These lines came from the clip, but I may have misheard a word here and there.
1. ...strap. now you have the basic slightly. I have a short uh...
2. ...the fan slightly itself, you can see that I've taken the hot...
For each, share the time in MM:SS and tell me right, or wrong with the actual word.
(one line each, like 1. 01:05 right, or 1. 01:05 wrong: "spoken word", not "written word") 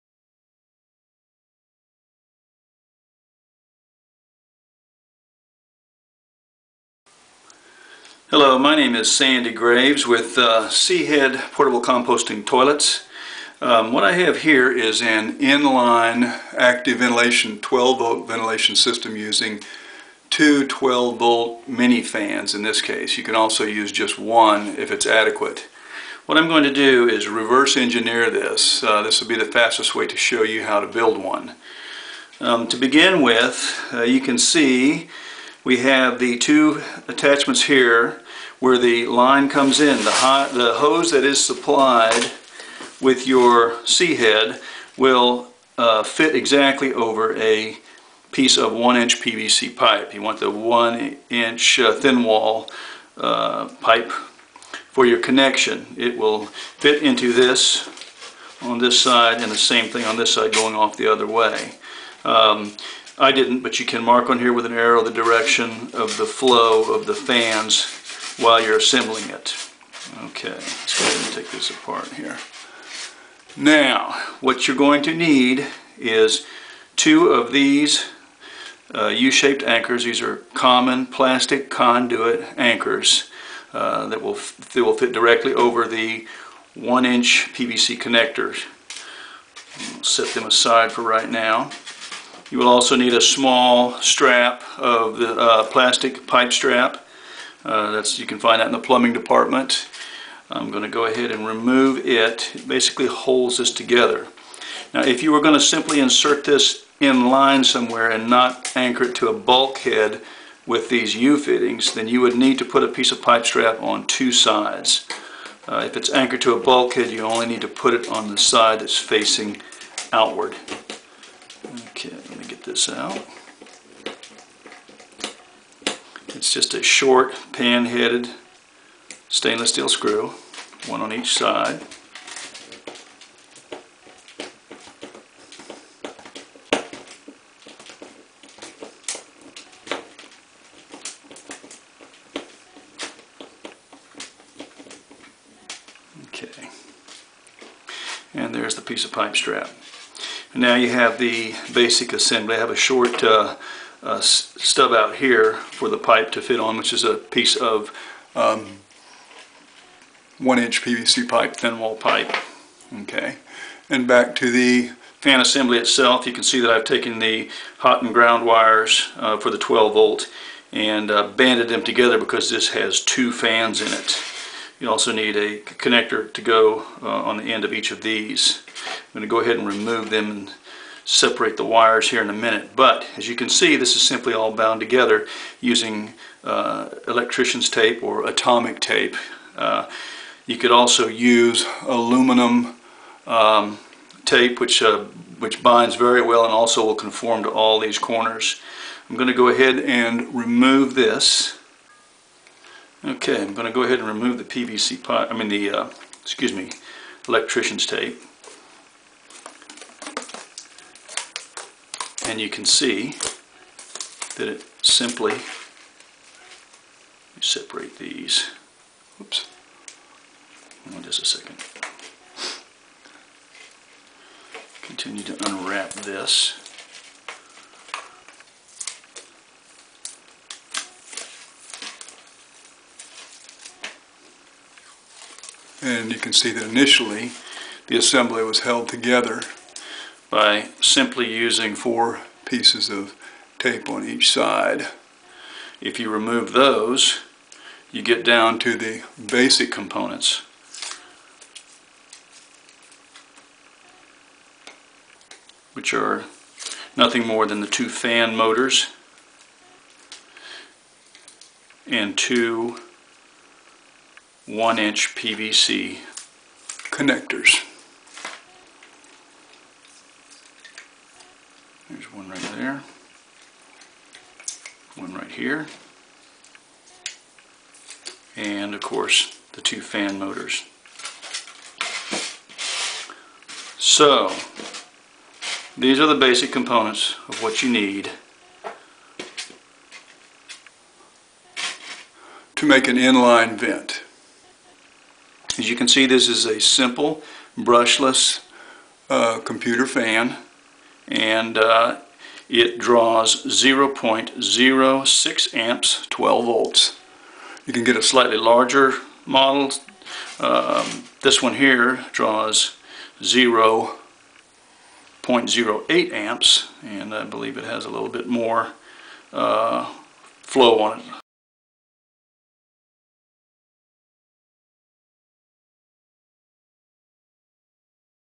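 1. 02:29 wrong: "assembly", not "slightly"
2. 02:44 wrong: "assembly", not "slightly".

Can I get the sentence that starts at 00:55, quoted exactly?
It will fit into this on this side and the same thing on this side going off the other way.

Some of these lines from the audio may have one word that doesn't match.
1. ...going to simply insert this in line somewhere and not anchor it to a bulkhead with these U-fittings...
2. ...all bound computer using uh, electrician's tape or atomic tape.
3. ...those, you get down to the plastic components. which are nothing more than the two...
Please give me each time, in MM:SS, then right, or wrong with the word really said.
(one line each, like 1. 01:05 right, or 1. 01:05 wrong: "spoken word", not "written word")
1. 01:45 right
2. 03:04 wrong: "together", not "computer"
3. 04:06 wrong: "basic", not "plastic".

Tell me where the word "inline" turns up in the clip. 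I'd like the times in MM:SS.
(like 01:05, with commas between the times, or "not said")
00:15, 04:52.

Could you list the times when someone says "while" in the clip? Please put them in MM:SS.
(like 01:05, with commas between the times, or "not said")
01:08.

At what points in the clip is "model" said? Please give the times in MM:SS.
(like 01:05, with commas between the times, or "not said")
05:09.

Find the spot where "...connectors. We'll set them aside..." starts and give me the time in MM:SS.
01:27.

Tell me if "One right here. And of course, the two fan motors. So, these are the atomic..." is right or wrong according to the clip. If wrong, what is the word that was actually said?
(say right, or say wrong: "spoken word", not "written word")
wrong: "basic", not "atomic".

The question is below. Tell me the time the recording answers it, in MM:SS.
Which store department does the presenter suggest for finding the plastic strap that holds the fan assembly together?
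01:38.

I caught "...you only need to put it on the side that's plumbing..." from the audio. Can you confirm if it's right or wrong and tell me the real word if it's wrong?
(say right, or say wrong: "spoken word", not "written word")
wrong: "facing", not "plumbing".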